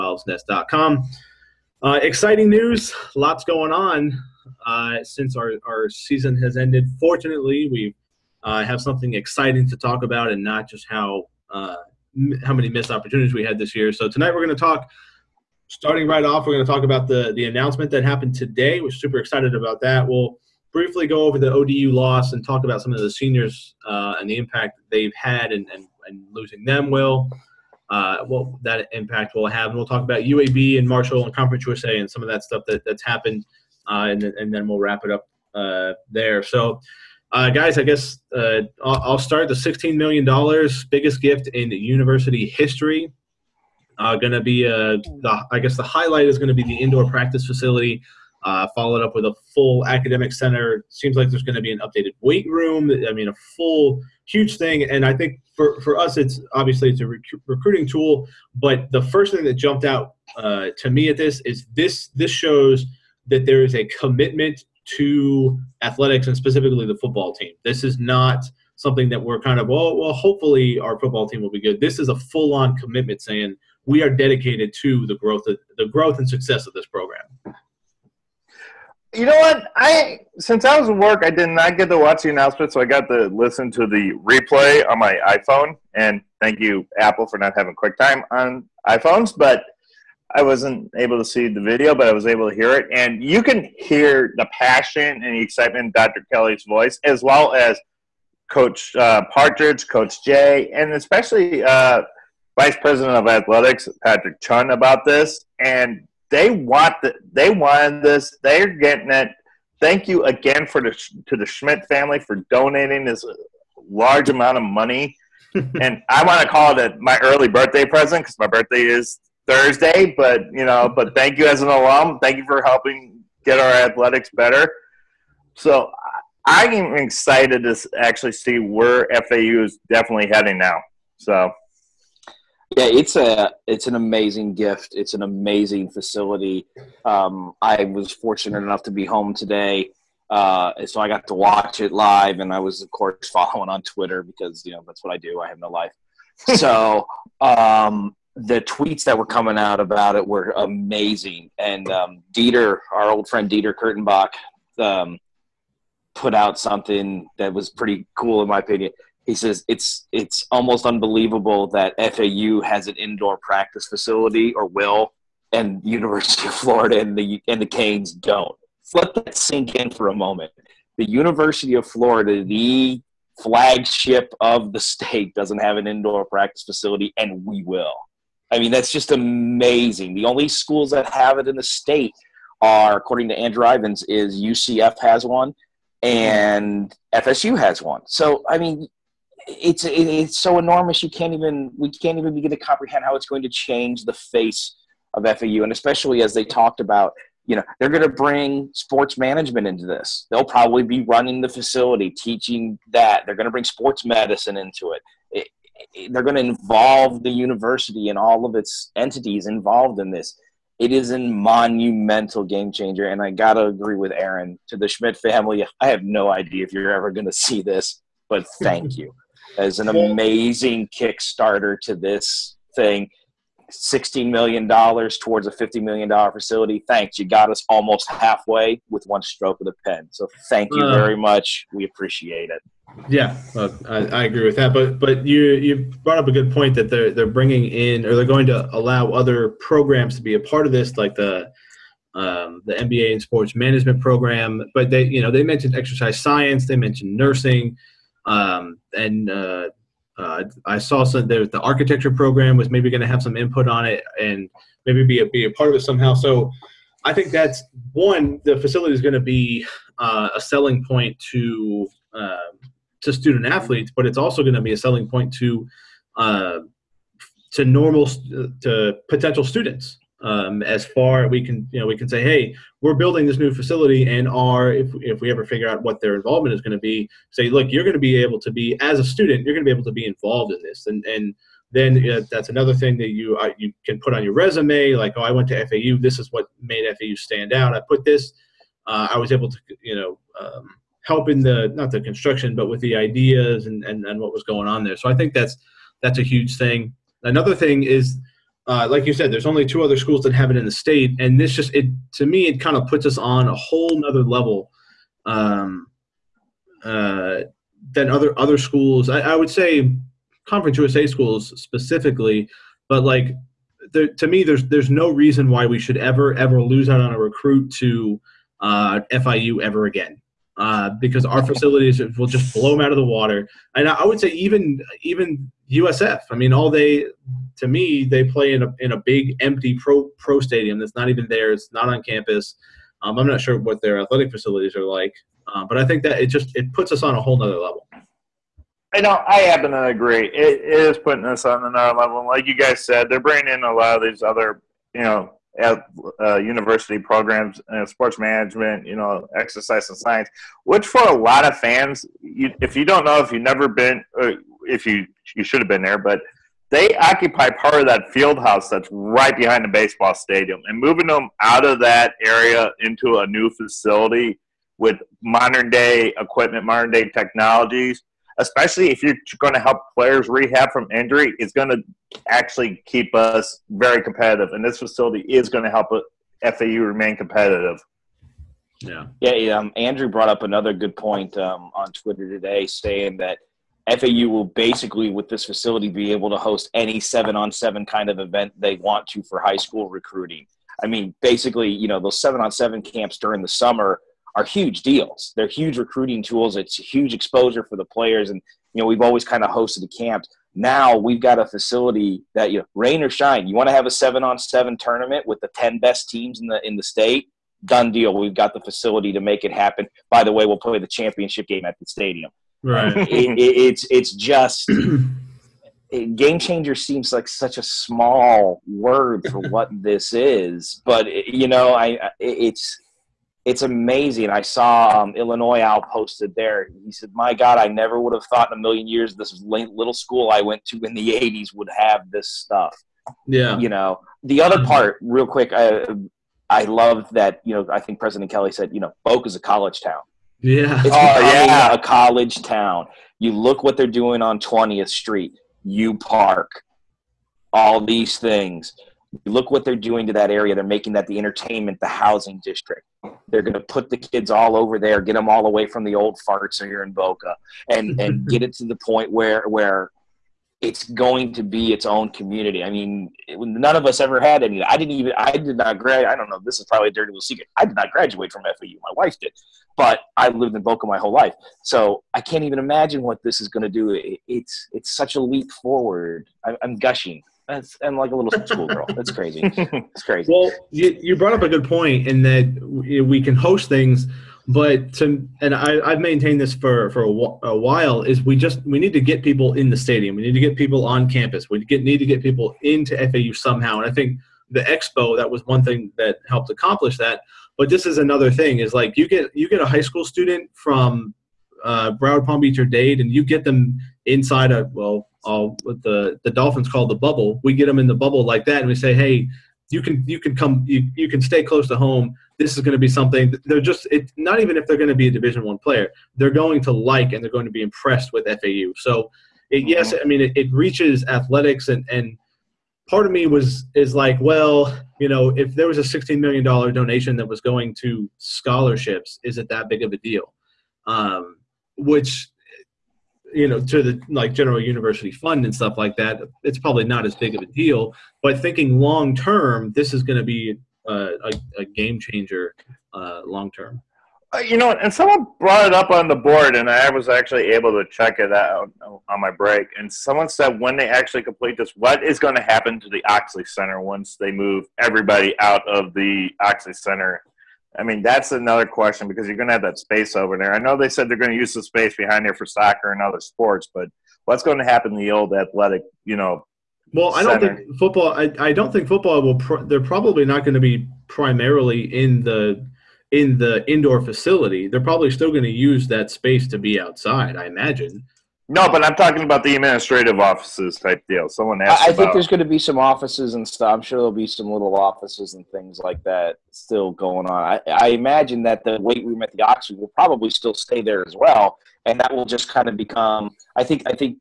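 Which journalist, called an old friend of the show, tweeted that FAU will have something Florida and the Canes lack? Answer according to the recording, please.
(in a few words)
Dieter Kurtenbach.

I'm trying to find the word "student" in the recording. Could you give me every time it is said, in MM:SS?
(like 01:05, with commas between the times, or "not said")
04:23, 04:29, 04:39, 08:20.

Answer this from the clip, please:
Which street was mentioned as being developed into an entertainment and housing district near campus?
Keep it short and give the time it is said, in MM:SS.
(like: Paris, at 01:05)
20th Street, at 07:24.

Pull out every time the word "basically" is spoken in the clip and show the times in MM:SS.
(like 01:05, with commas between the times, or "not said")
06:24, 06:31.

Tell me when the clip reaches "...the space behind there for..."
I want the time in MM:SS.
09:21.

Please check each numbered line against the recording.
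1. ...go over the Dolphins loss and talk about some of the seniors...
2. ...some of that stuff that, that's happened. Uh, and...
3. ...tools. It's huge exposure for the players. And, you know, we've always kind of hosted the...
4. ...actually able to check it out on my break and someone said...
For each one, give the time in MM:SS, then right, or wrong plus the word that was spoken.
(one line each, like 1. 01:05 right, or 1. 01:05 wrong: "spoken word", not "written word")
1. 00:21 wrong: "ODU", not "Dolphins"
2. 00:32 right
3. 06:36 right
4. 09:07 right.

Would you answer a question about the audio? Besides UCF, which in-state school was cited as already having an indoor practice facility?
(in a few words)
FSU.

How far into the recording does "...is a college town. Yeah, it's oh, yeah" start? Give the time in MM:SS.
07:19.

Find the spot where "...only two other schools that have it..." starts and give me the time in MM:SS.
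04:59.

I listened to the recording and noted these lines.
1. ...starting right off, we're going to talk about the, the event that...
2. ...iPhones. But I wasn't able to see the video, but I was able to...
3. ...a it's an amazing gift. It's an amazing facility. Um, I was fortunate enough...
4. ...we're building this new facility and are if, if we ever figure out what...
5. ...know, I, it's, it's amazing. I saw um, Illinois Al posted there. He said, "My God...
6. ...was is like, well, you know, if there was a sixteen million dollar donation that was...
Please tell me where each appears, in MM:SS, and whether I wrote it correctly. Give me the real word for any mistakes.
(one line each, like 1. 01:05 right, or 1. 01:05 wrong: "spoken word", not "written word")
1. 00:15 wrong: "announcement", not "event"
2. 01:28 right
3. 02:13 right
4. 04:32 right
5. 07:01 right
6. 08:43 right.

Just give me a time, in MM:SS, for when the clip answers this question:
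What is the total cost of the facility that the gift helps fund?
03:45.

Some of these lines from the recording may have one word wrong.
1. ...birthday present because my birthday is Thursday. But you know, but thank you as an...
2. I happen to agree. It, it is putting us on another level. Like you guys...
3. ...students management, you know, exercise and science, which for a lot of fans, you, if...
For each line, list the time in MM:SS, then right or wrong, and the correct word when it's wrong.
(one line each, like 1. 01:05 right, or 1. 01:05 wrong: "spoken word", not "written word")
1. 01:57 right
2. 05:39 right
3. 05:47 wrong: "sports", not "students".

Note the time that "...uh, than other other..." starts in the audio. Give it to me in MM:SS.
05:06.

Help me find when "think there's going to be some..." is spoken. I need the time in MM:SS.
09:41.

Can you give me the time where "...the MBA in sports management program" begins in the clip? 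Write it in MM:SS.
04:02.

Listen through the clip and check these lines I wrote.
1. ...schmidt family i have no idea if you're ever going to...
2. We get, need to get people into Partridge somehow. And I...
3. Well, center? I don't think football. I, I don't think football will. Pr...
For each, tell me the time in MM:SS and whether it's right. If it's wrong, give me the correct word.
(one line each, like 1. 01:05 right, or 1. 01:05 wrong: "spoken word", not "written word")
1. 03:34 right
2. 08:11 wrong: "FAU", not "Partridge"
3. 09:26 right.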